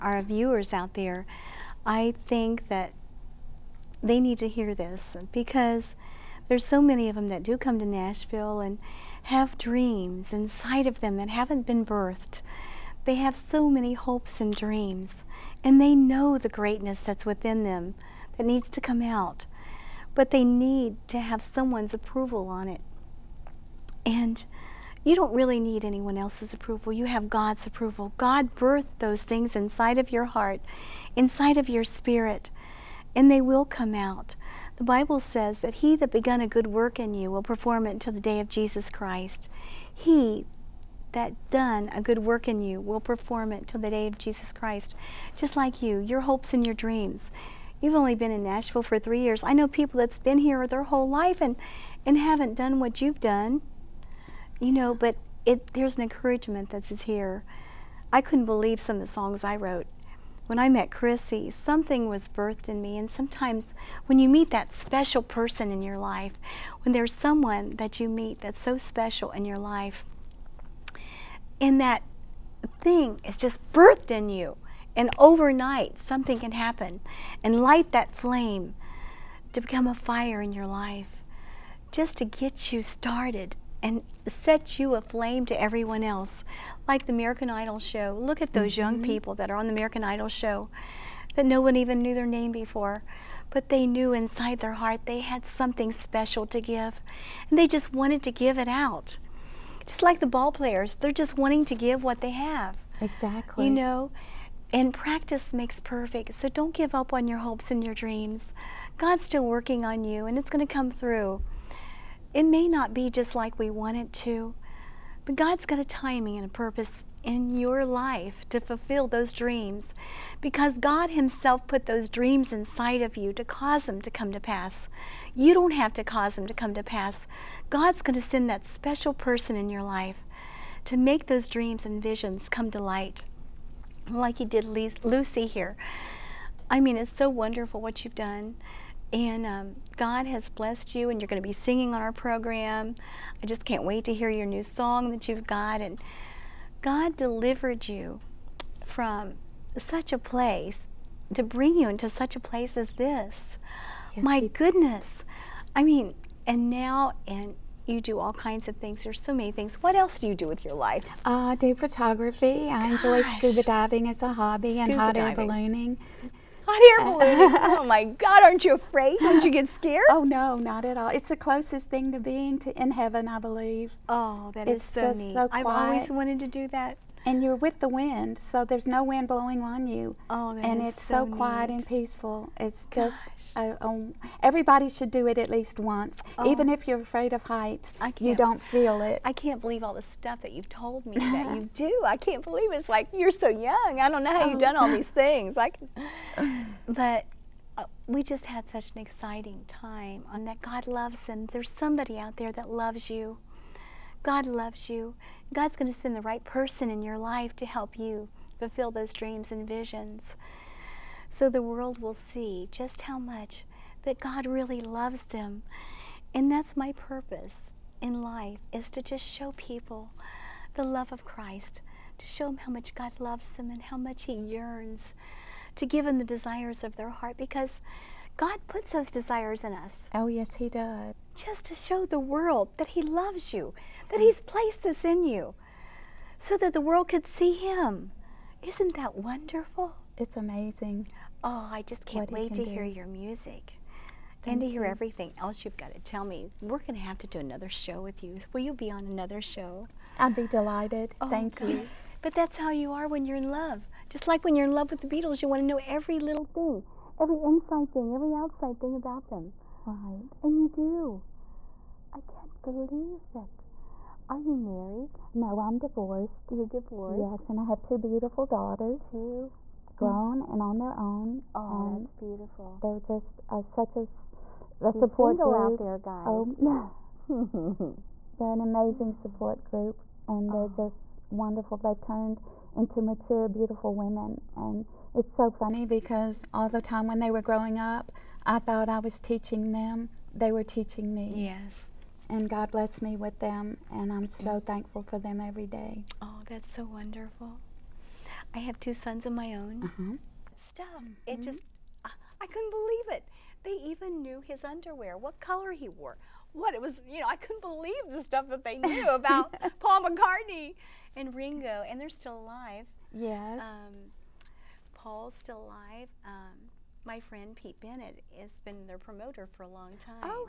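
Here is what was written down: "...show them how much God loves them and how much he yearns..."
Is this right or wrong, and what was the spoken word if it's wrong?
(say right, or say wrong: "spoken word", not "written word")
right.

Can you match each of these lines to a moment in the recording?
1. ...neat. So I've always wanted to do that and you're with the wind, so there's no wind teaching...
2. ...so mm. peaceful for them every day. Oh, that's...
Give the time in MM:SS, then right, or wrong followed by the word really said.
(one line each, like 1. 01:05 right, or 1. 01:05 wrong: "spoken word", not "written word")
1. 02:55 wrong: "blowing", not "teaching"
2. 04:54 wrong: "thankful", not "peaceful".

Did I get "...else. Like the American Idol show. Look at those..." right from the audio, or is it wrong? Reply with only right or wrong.
right.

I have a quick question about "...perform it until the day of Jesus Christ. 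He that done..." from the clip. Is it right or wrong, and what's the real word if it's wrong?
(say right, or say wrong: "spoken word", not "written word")
right.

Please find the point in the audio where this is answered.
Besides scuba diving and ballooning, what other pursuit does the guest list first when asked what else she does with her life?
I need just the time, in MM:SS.
02:41.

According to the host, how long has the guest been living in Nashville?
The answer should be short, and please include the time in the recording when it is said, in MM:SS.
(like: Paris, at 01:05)
3 years, at 00:48.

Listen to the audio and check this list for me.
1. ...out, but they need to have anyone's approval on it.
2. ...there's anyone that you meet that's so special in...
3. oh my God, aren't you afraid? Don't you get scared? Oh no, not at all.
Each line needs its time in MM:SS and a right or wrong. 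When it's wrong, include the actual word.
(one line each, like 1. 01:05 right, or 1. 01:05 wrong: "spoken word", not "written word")
1. 00:18 wrong: "someone", not "anyone"
2. 01:06 wrong: "someone", not "anyone"
3. 02:47 right.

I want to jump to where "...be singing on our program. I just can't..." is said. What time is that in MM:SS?
02:21.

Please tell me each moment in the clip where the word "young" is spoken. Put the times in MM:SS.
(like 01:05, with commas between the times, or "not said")
01:28, 03:13.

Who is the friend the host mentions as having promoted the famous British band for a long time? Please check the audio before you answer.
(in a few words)
Pete Bennett.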